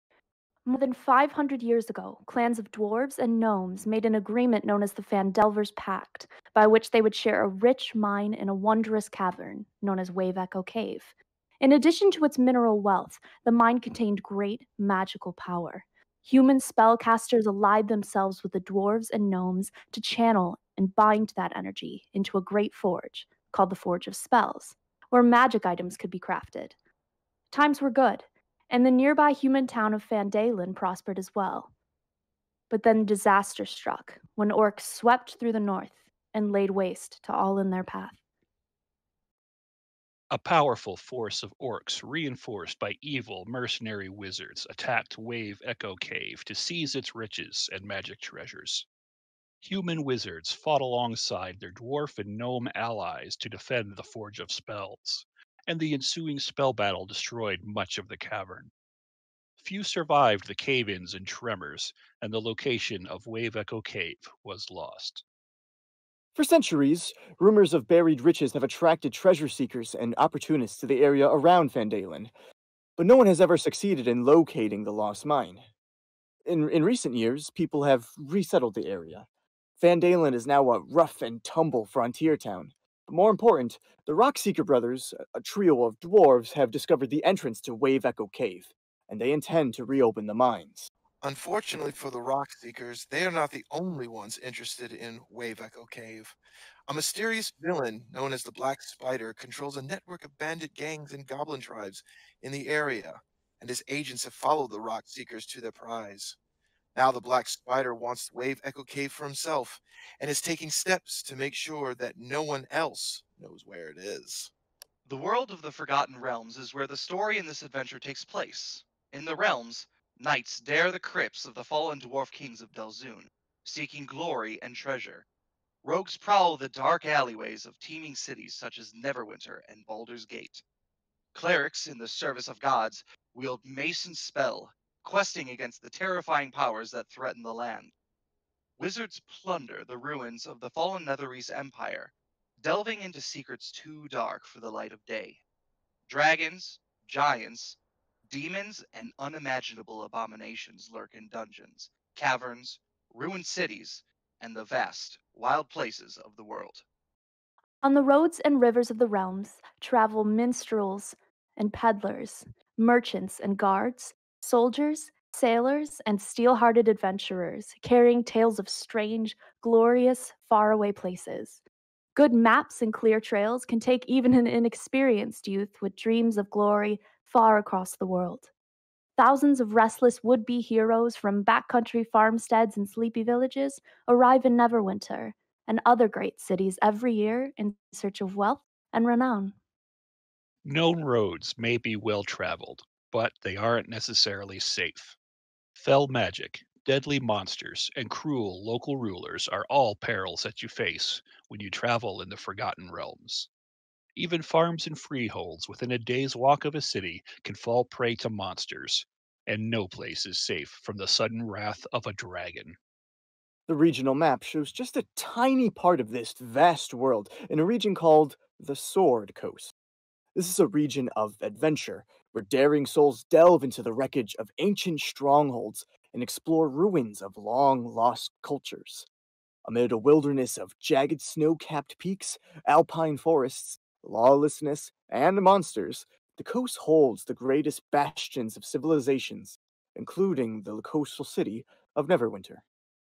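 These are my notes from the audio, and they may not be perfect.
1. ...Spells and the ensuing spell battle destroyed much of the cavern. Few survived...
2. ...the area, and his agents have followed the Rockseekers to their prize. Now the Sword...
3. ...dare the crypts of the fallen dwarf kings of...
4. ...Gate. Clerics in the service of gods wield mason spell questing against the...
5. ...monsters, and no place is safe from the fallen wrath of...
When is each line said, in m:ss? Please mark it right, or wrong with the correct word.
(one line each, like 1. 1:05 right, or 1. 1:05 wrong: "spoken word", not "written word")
1. 0:54 right
2. 1:42 wrong: "Black", not "Sword"
3. 2:00 right
4. 2:10 right
5. 3:28 wrong: "sudden", not "fallen".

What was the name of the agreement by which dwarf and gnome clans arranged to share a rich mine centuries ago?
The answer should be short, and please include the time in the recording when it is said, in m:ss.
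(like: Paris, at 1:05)
Phandelver's Pact, at 0:05.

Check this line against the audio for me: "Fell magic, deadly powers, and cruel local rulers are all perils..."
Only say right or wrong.
wrong.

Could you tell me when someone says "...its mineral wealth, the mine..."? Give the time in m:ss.
0:12.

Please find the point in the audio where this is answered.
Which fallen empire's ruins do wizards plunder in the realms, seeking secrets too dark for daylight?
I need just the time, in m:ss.
2:21.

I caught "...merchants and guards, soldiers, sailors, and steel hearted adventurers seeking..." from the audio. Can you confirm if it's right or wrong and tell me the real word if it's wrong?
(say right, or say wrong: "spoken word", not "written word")
wrong: "carrying", not "seeking".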